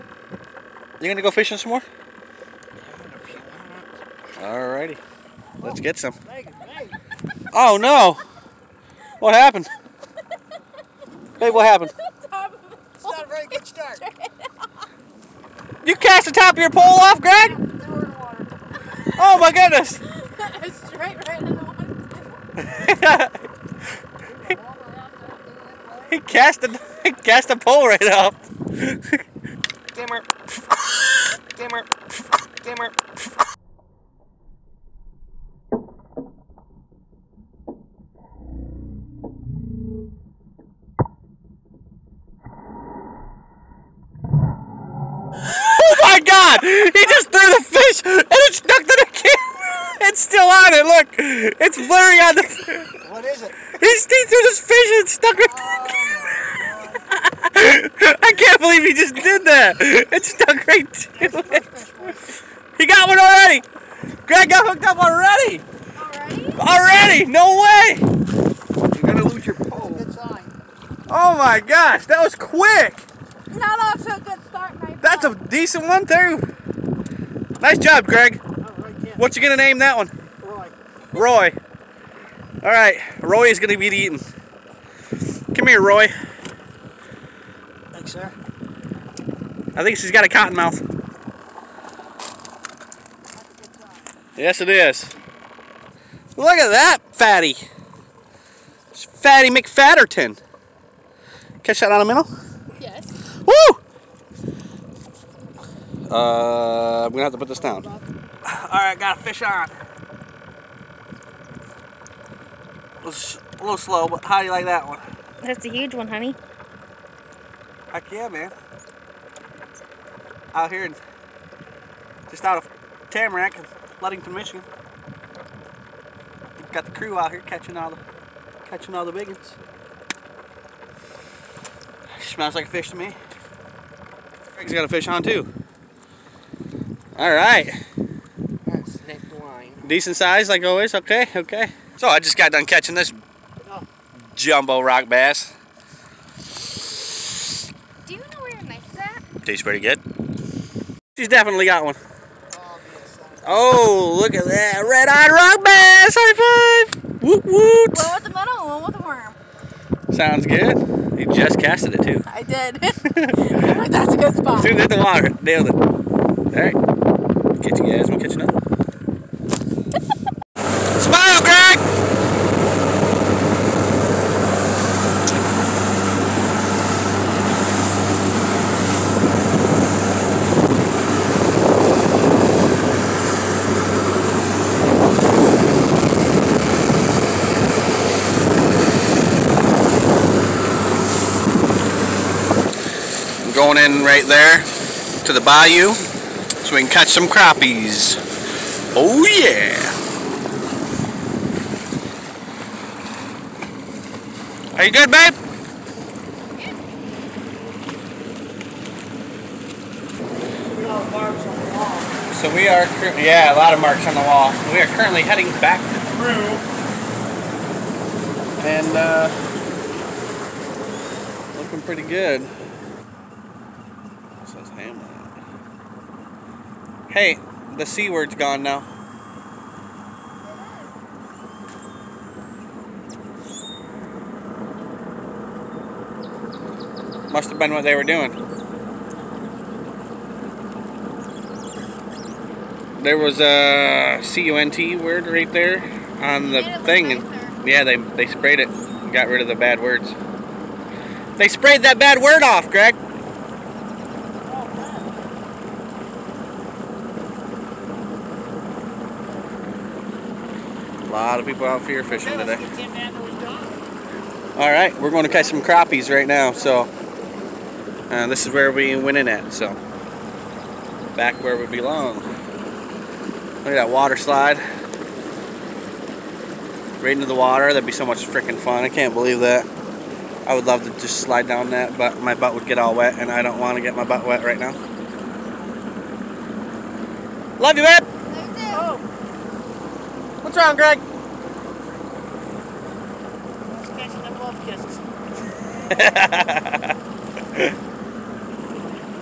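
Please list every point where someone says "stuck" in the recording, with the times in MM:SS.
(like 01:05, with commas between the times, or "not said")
00:48, 00:55, 01:00.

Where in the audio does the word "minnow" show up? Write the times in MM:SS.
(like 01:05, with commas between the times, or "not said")
01:42.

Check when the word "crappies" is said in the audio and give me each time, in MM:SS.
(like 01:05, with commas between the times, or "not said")
03:17, 04:25.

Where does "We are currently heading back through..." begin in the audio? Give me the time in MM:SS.
03:34.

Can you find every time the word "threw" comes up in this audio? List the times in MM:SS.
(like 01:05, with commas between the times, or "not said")
00:47, 00:53.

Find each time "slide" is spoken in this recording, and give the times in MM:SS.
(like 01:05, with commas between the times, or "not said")
04:34, 04:41.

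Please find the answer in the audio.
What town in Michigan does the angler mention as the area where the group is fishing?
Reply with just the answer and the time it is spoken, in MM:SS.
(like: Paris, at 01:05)
Ludington, at 02:03.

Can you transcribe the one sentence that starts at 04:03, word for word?
There was a C-U-N-T word right there on the thing.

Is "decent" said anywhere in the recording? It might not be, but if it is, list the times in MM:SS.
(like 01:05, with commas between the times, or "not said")
01:15, 02:19.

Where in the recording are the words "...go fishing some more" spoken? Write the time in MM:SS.
00:01.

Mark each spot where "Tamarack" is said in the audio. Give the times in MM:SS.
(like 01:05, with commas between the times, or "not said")
02:03.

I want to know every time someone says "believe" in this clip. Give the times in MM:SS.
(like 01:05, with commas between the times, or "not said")
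00:58, 04:39.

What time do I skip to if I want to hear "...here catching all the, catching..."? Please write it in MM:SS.
02:07.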